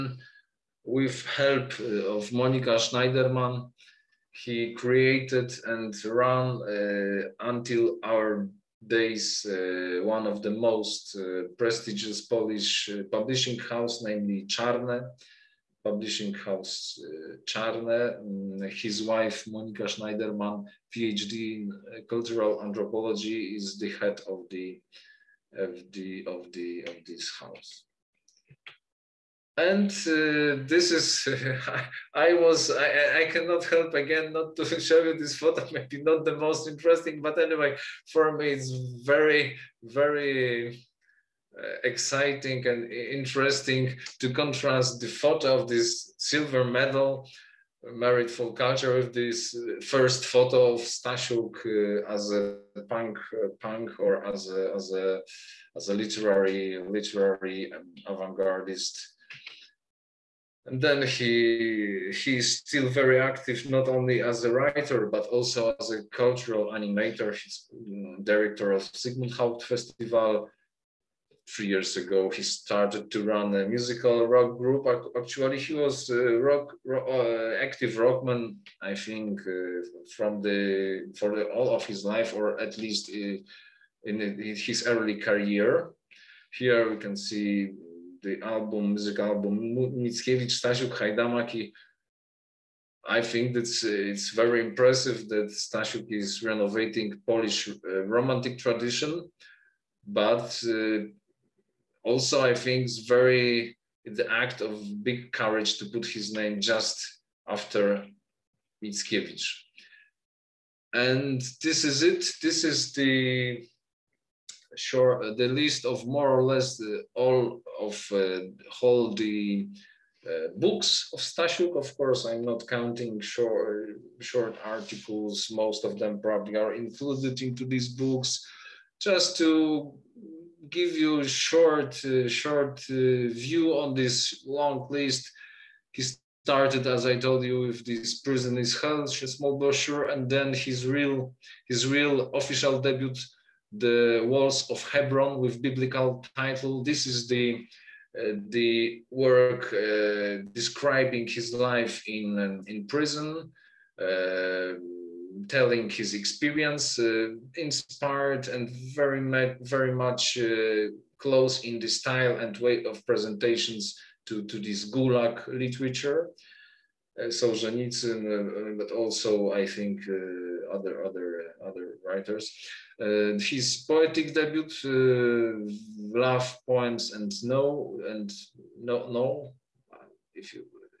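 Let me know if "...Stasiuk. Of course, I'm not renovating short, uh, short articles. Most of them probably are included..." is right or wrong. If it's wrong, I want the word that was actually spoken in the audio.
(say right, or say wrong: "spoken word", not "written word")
wrong: "counting", not "renovating".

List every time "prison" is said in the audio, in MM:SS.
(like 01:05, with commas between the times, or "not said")
02:18, 02:32.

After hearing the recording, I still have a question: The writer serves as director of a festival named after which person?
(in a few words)
Zygmunt Haupt.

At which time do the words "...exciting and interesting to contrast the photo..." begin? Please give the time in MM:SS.
00:41.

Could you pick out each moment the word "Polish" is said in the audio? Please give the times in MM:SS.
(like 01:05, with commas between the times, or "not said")
00:12, 01:37.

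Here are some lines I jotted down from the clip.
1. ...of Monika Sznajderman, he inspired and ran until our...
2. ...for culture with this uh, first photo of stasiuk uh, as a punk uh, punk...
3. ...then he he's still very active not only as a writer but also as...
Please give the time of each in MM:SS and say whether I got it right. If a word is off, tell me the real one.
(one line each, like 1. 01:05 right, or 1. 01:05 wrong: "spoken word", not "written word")
1. 00:02 wrong: "created", not "inspired"
2. 00:48 right
3. 01:00 right.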